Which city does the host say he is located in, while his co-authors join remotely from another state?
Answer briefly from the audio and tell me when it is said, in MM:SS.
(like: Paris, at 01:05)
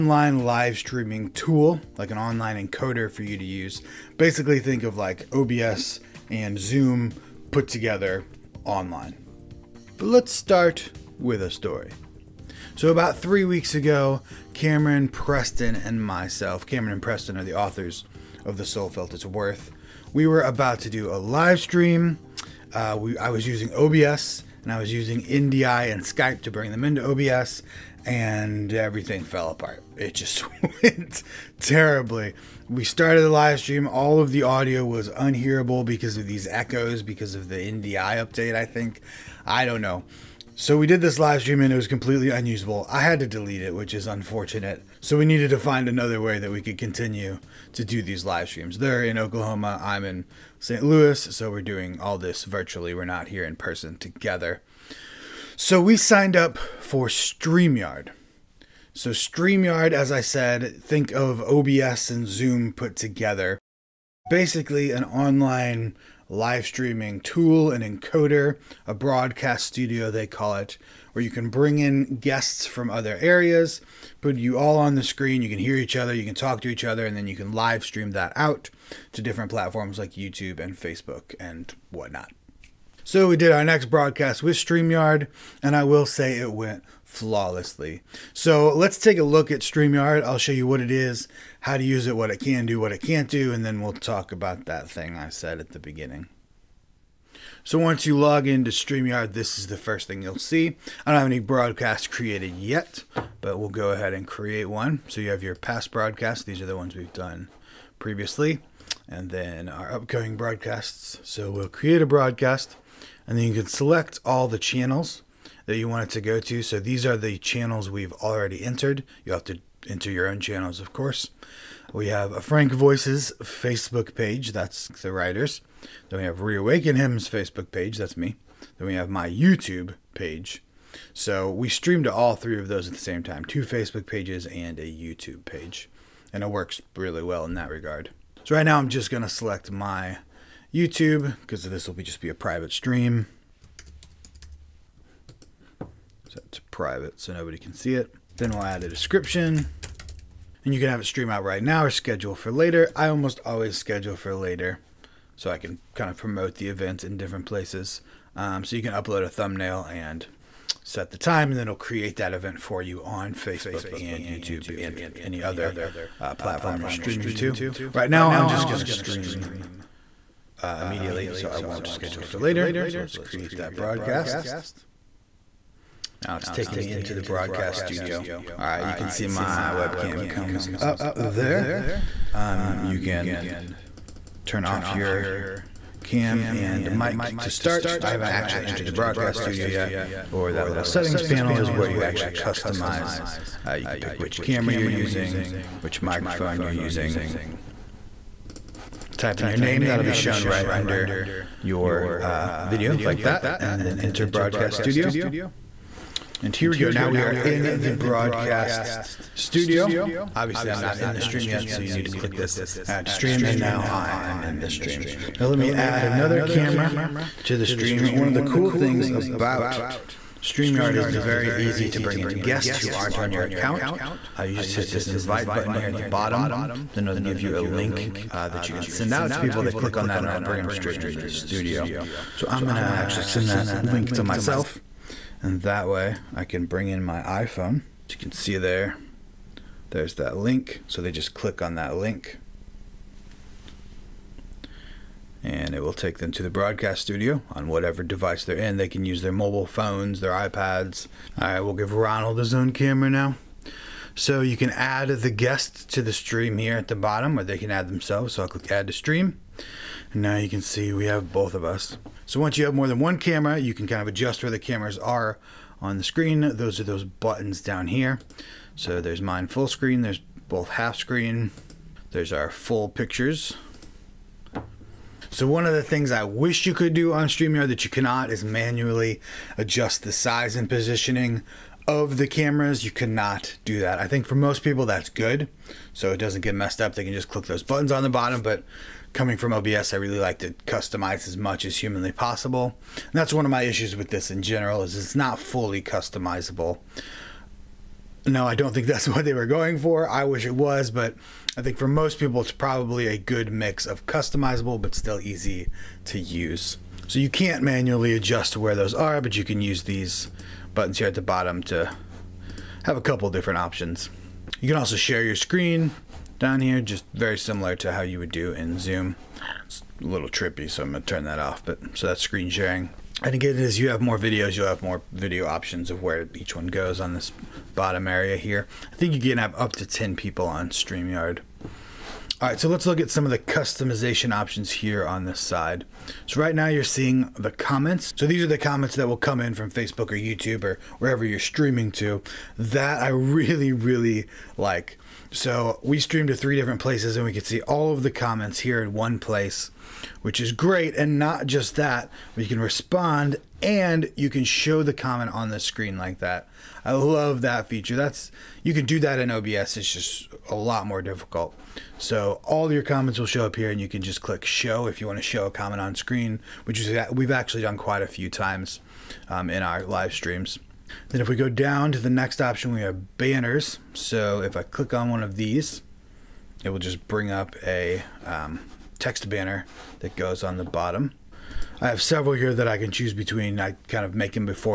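St. Louis, at 00:50.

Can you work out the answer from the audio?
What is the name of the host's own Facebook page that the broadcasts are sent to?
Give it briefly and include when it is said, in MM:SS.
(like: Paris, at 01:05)
Reawaken Hymns, at 02:06.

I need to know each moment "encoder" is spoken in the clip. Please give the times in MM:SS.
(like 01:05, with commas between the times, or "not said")
00:02, 01:07.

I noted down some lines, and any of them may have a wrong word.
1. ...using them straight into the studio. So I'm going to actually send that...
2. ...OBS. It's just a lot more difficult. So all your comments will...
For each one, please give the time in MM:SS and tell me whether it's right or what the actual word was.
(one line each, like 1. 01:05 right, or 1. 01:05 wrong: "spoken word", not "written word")
1. 03:50 wrong: "bring", not "using"
2. 05:59 right.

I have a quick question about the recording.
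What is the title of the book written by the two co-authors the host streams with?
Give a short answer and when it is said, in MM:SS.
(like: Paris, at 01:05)
The Soul Felt Its Worth, at 00:18.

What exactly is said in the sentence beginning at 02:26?
Set to private so nobody can see it.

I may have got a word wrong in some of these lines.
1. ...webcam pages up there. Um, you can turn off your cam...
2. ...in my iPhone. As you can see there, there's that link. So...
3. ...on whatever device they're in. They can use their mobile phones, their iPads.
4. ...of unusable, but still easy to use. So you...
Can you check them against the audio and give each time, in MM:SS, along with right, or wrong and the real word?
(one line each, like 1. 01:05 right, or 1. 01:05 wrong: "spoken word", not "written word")
1. 02:59 wrong: "comes", not "pages"
2. 03:56 right
3. 04:07 right
4. 05:03 wrong: "customizable", not "unusable".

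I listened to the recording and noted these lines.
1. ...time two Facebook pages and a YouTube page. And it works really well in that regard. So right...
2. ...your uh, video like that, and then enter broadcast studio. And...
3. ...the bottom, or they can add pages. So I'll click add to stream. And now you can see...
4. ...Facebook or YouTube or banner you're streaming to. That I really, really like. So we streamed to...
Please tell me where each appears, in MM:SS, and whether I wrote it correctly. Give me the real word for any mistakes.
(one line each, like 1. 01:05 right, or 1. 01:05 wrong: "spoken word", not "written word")
1. 02:13 right
2. 03:21 right
3. 04:16 wrong: "themselves", not "pages"
4. 05:39 wrong: "wherever", not "banner".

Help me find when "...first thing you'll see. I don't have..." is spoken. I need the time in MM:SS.
01:39.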